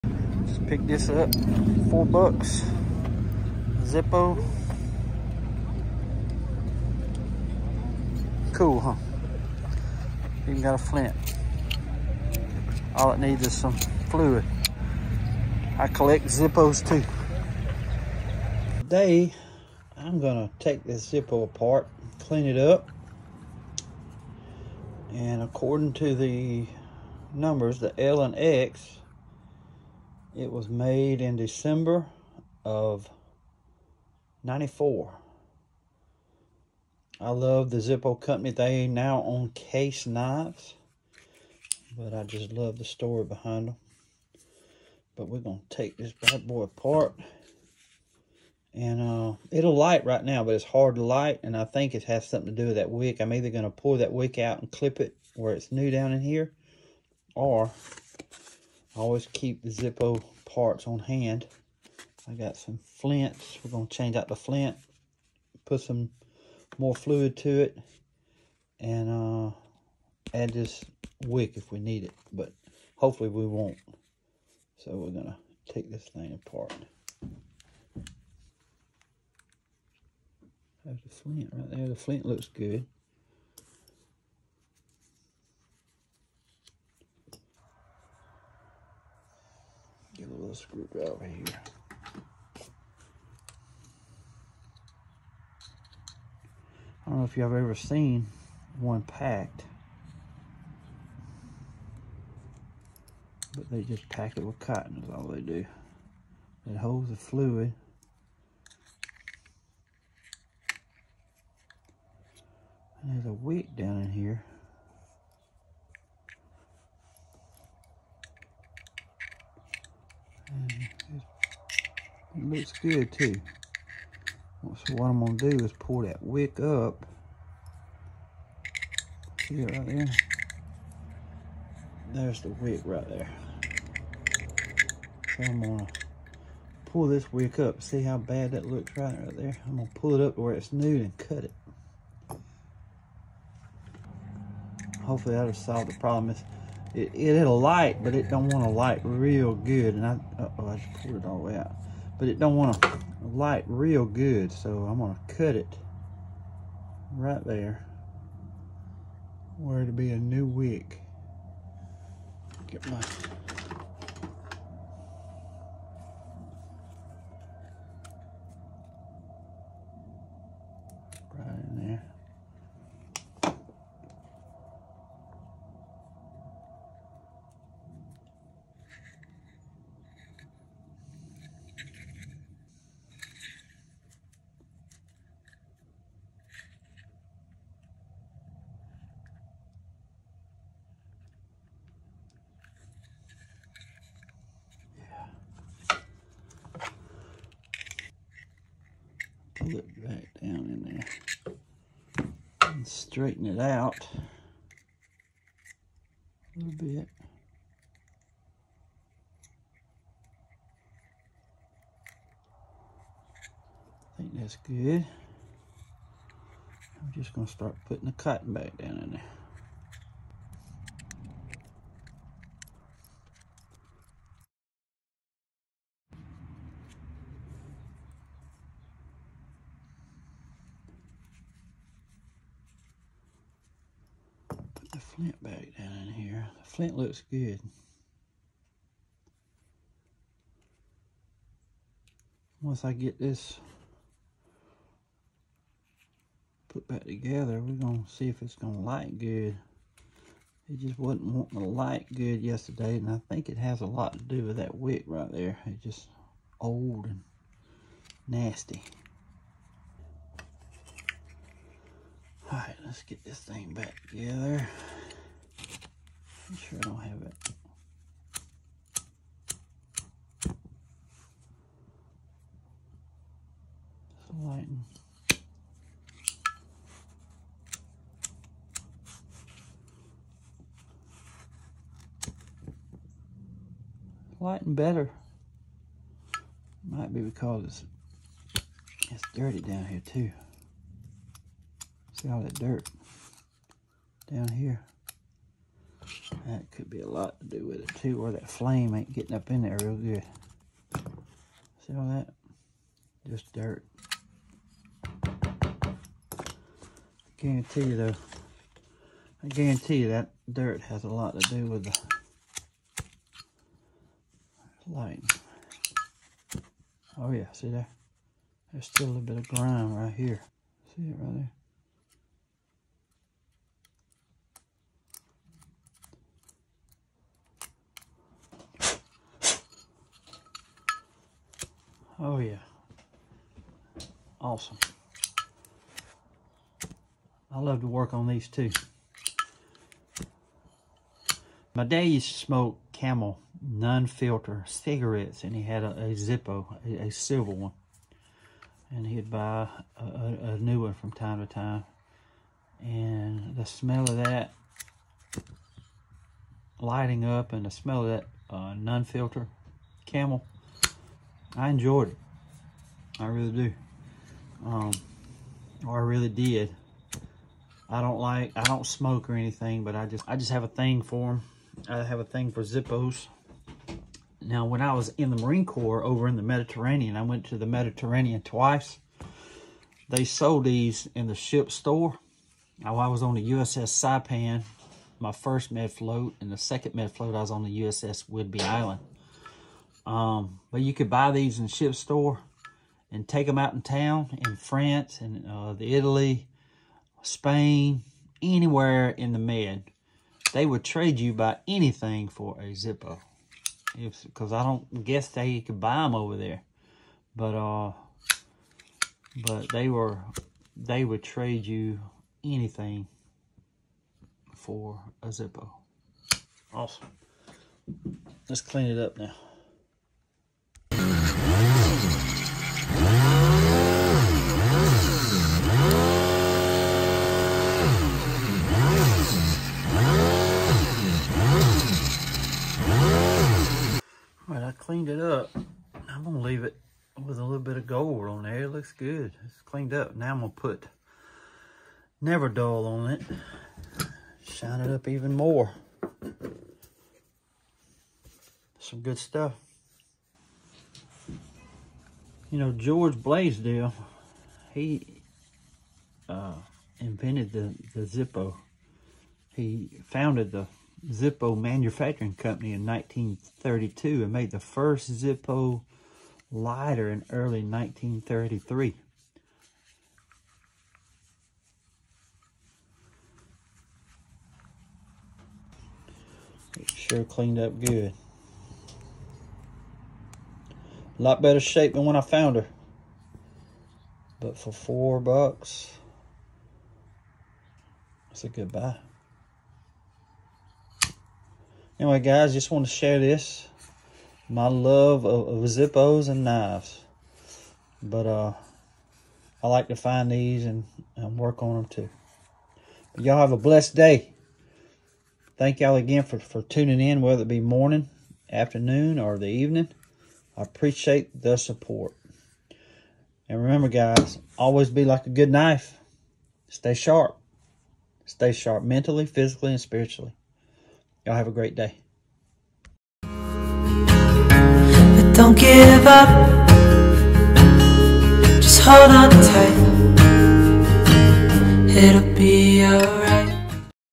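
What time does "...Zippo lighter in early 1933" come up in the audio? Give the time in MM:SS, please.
07:45.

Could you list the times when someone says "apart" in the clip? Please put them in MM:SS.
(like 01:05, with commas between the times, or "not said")
00:21, 00:46, 01:16.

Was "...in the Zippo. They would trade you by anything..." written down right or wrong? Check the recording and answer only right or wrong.
wrong.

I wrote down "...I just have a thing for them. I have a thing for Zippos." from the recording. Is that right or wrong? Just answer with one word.
right.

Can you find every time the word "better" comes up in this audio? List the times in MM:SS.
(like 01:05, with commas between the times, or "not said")
04:44, 08:01.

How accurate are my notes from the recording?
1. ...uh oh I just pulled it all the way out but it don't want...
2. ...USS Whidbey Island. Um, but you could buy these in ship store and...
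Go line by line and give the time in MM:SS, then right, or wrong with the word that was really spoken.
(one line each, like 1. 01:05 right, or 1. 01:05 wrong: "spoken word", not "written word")
1. 02:30 right
2. 06:27 right.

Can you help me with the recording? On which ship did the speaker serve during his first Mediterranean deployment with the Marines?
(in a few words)
USS Saipan.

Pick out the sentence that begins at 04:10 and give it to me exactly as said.
It just wasn't wanting to light good yesterday, and I think it has a lot to do with that wick right there.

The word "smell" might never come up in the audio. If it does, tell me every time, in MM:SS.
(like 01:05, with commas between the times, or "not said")
05:53, 05:57.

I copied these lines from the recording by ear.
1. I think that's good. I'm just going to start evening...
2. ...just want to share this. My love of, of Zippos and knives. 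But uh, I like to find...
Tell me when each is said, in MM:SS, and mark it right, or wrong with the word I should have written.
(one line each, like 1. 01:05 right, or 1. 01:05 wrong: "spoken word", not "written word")
1. 03:34 wrong: "putting", not "evening"
2. 08:12 right.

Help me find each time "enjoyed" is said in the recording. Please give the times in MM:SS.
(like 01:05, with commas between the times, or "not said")
06:01.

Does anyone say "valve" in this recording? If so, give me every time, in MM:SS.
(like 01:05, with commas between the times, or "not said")
01:30.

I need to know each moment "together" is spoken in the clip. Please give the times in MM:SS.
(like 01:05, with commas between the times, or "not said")
04:07, 04:24.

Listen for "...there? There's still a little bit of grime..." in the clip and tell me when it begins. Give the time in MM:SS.
05:17.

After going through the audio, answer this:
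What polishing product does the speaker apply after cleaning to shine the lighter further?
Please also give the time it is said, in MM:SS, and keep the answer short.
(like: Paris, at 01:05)
Never Dull, at 07:22.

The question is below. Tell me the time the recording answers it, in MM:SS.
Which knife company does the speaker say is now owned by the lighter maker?
00:39.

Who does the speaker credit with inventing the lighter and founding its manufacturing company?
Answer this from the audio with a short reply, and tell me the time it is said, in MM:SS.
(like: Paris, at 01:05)
George Blaisdell, at 07:32.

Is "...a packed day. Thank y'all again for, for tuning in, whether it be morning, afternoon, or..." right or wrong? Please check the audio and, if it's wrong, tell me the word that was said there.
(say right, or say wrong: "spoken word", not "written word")
wrong: "blessed", not "packed".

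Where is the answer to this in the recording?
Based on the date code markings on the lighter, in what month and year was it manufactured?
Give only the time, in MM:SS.
00:31.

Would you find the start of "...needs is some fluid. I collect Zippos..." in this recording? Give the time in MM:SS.
00:13.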